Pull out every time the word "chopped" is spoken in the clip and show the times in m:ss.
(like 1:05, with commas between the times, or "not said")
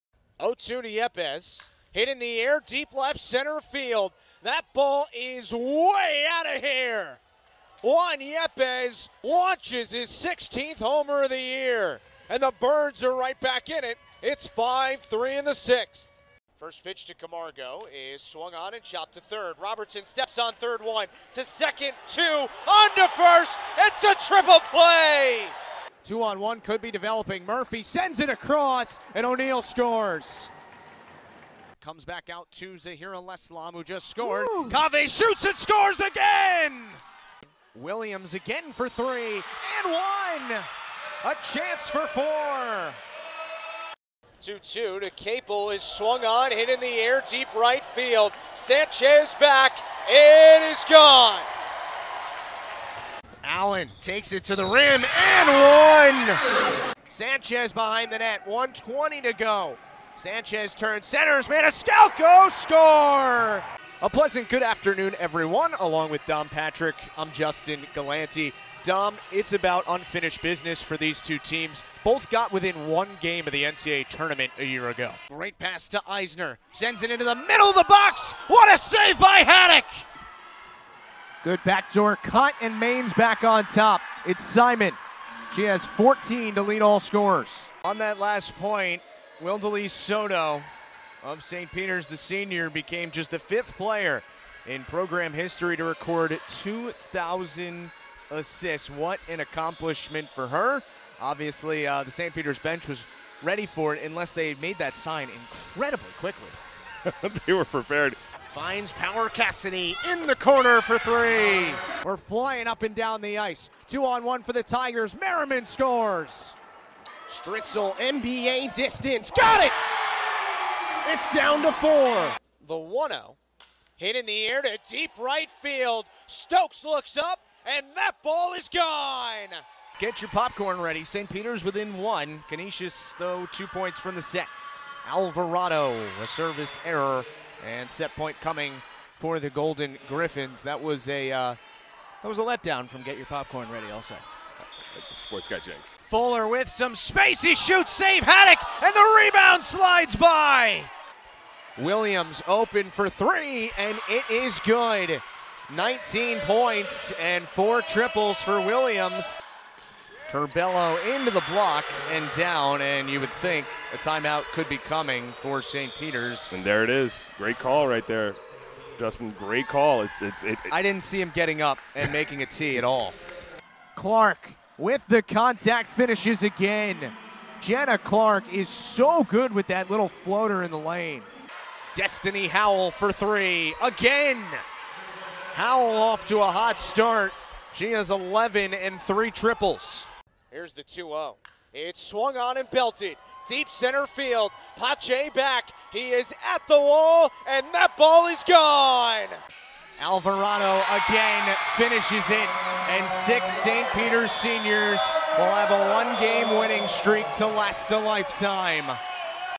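0:18.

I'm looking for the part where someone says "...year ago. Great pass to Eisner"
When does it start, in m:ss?
1:14.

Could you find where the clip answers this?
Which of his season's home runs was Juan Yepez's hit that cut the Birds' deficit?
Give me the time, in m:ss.
0:10.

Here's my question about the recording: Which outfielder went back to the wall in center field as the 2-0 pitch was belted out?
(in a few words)
Pache.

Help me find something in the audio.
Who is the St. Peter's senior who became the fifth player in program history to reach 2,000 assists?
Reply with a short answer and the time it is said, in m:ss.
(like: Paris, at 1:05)
Wildelee Soto, at 1:29.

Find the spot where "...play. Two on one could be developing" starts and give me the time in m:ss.
0:24.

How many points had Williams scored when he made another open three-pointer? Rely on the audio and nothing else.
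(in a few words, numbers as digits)
19.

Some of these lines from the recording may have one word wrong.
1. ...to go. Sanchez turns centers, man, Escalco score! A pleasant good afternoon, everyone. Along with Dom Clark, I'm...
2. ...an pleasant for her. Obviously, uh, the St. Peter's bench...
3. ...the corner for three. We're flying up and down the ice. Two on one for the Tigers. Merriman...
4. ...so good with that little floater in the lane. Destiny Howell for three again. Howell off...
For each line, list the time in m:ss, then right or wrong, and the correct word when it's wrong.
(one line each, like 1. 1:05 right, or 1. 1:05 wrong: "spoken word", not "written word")
1. 0:59 wrong: "Patrick", not "Clark"
2. 1:39 wrong: "accomplishment", not "pleasant"
3. 1:50 right
4. 2:58 right.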